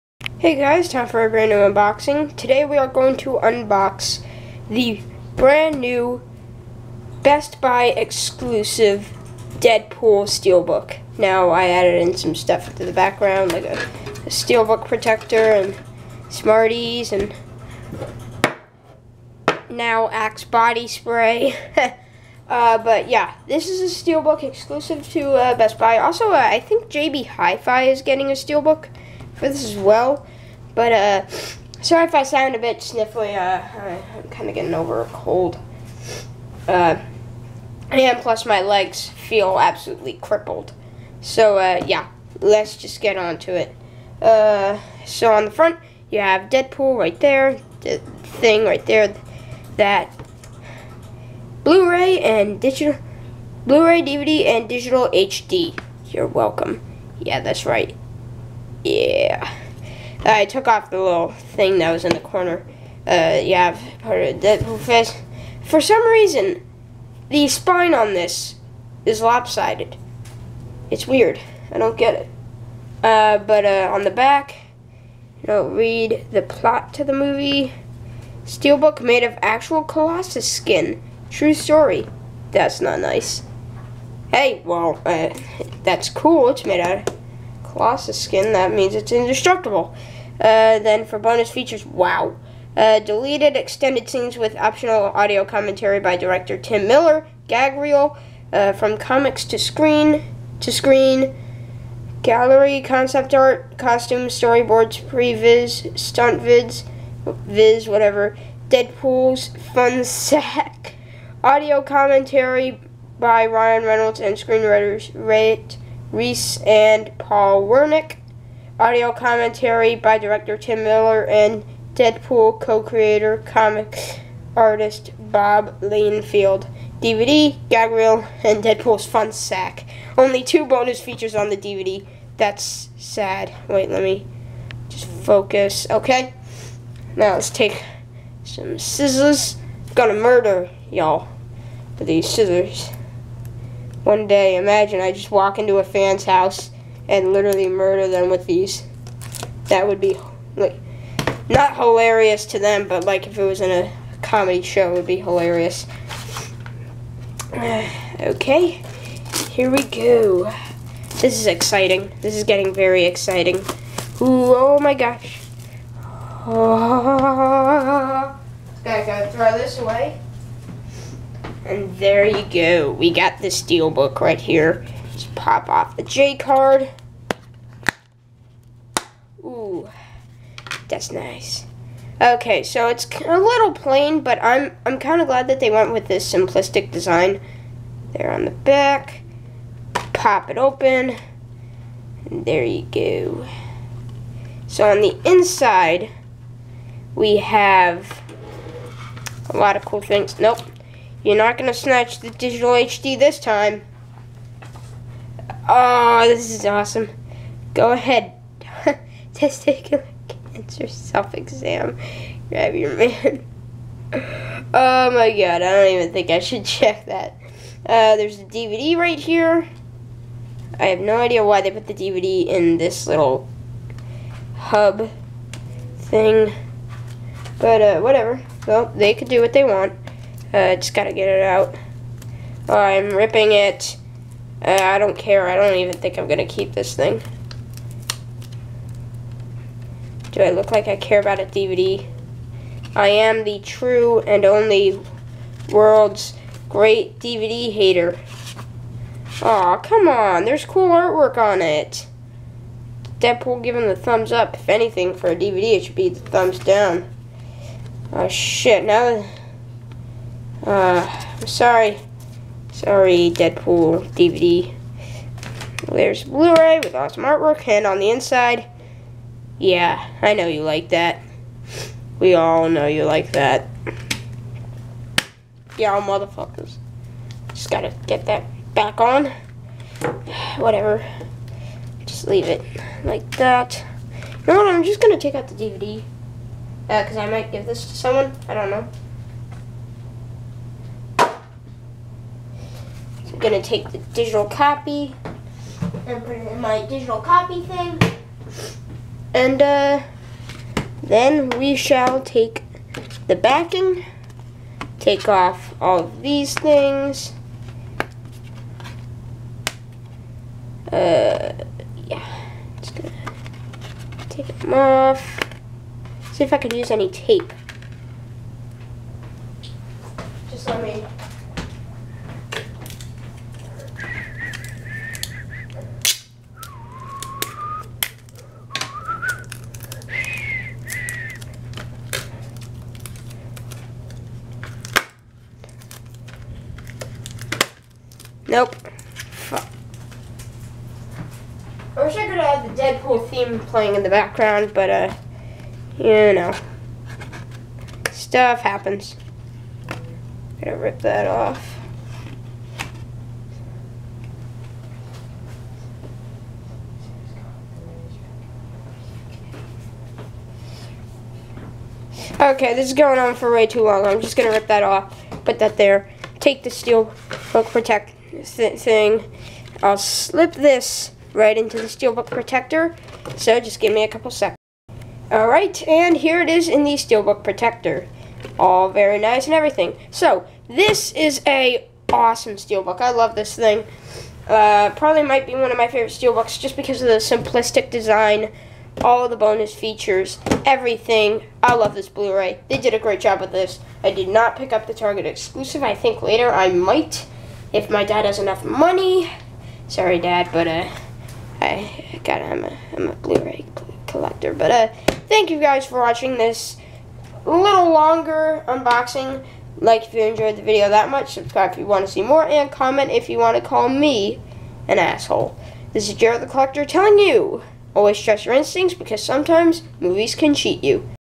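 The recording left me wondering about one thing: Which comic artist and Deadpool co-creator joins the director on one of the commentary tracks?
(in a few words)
Bob Liefeld.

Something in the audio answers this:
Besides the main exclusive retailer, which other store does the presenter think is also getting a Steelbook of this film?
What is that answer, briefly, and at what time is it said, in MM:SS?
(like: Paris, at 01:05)
JB Hi-Fi, at 00:26.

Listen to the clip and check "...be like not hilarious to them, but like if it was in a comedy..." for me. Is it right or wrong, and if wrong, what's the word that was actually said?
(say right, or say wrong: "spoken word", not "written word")
right.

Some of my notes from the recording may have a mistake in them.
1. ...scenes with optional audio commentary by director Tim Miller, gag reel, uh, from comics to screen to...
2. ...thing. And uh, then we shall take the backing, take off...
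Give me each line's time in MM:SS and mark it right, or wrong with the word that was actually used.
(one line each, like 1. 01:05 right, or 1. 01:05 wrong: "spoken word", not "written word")
1. 01:34 right
2. 04:57 right.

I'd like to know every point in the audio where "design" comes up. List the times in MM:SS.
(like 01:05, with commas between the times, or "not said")
03:06, 06:27.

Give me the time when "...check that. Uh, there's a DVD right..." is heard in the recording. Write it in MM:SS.
03:36.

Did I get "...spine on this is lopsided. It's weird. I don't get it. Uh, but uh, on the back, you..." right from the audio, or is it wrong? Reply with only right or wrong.
right.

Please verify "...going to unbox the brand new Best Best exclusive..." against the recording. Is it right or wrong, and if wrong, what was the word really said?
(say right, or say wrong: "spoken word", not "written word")
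wrong: "Buy", not "Best".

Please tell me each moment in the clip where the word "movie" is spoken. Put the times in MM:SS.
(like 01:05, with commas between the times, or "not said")
01:17, 06:59.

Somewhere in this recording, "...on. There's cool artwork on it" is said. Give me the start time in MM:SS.
04:10.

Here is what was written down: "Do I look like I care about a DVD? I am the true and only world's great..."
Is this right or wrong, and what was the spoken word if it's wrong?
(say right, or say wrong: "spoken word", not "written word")
right.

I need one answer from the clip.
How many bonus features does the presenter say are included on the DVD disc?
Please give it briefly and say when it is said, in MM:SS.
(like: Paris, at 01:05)
2, at 02:10.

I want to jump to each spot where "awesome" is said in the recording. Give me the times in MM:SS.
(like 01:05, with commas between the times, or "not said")
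03:26, 04:26, 06:22.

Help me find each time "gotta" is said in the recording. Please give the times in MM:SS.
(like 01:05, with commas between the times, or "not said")
02:49, 03:50, 04:37, 05:50, 06:42.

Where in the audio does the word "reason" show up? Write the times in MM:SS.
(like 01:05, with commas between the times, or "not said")
01:06.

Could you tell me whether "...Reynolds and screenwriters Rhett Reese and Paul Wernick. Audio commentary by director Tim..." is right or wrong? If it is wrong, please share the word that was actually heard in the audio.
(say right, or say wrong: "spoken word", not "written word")
right.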